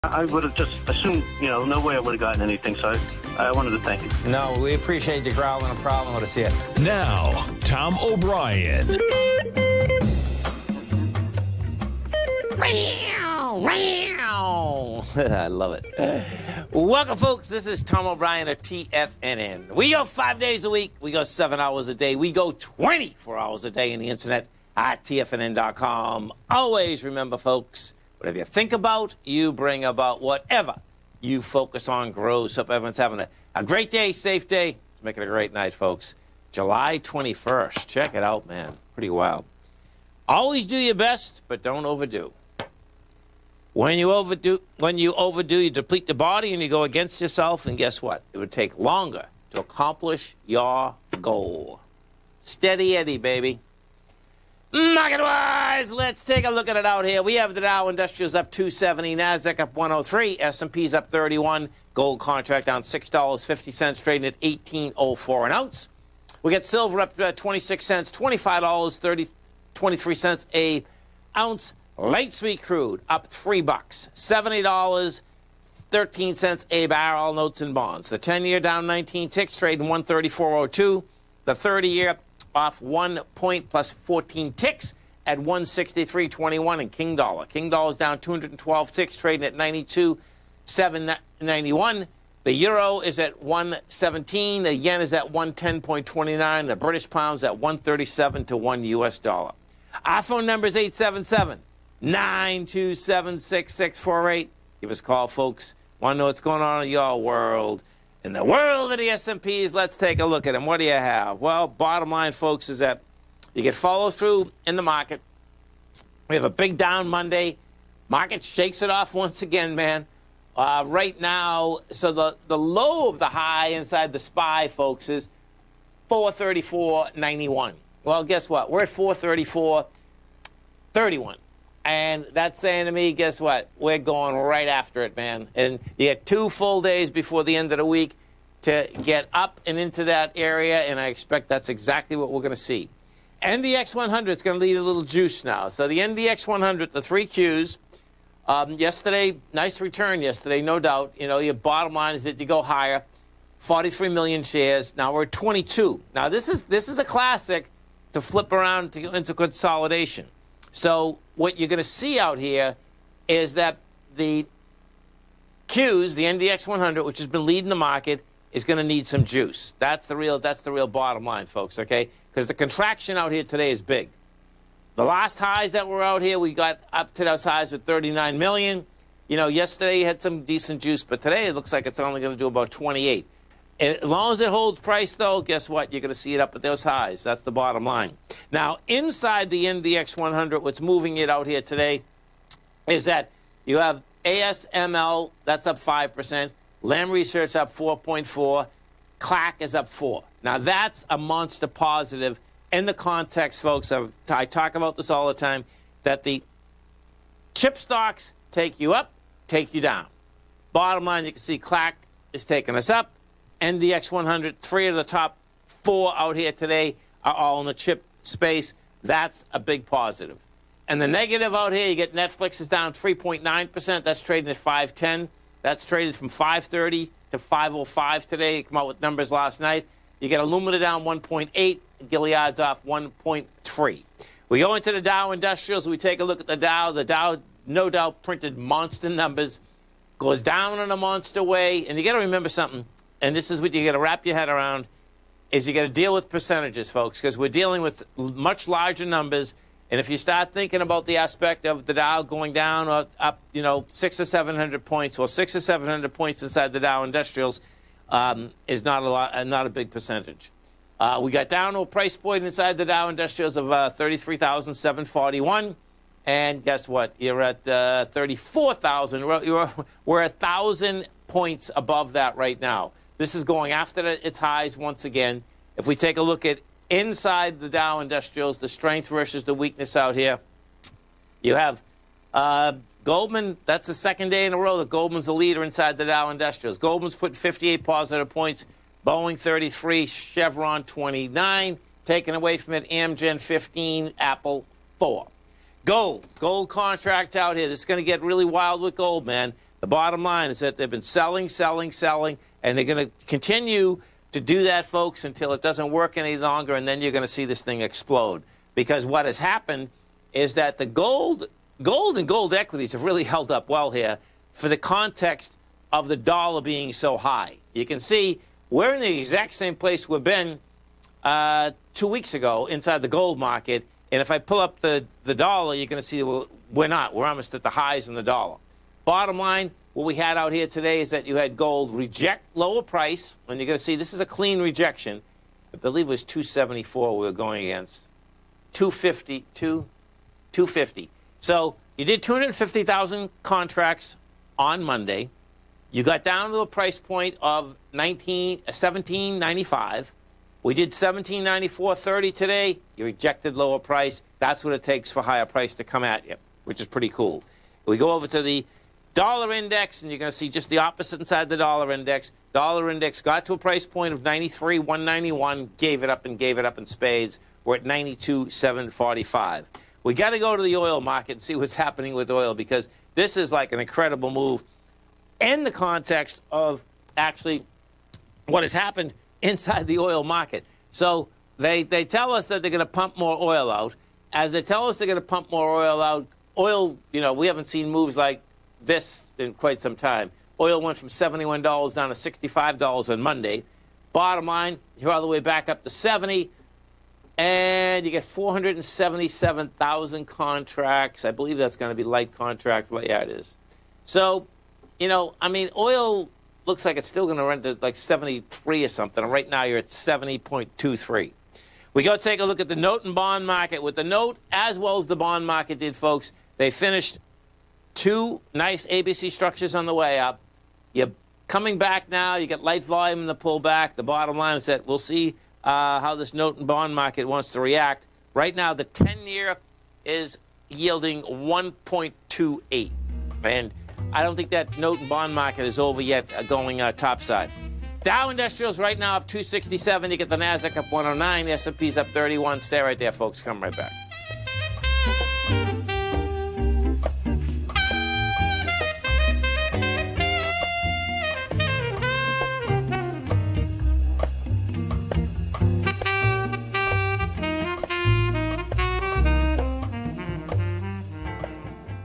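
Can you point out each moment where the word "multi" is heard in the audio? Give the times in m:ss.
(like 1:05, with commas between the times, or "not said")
not said.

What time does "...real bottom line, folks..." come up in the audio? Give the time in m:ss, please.
2:50.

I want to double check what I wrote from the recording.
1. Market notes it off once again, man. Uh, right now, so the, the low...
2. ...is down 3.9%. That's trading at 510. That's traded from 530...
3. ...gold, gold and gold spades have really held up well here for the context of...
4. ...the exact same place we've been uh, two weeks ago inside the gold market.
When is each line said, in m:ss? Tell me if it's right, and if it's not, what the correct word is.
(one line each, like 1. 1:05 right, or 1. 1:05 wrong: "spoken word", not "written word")
1. 1:58 wrong: "shakes", not "notes"
2. 3:42 right
3. 5:10 wrong: "equities", not "spades"
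4. 5:19 right.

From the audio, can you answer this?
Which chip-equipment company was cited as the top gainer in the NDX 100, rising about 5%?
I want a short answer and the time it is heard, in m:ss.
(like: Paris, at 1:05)
ASML, at 3:14.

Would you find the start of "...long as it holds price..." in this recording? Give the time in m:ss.
3:04.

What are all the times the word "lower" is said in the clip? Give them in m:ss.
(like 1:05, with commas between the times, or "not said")
5:32, 5:53.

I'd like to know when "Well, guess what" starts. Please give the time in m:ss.
2:08.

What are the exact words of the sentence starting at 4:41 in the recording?
You have uh, Goldman, that's the second day in a row that Goldman's the leader inside the Dow Industrials.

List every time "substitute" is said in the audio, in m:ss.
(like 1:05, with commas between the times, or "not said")
not said.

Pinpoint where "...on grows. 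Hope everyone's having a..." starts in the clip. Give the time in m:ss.
0:31.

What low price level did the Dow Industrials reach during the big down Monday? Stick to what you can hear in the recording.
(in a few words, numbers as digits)
33,741.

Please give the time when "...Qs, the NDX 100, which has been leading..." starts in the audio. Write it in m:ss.
2:45.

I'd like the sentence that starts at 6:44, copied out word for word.
So, you know, I mean, oil looks like it's still going to run to like 73 or something.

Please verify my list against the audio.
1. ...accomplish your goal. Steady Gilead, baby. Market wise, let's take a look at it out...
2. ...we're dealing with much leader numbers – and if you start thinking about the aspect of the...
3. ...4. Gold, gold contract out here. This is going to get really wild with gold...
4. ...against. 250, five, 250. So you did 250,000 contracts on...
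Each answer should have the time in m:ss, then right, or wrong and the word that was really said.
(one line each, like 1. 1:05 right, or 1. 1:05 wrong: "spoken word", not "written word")
1. 0:49 wrong: "Eddie", not "Gilead"
2. 4:07 wrong: "larger", not "leader"
3. 4:54 right
4. 5:37 wrong: "two", not "five".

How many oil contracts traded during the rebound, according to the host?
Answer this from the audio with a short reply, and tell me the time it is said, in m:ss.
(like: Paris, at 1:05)
477,000, at 6:38.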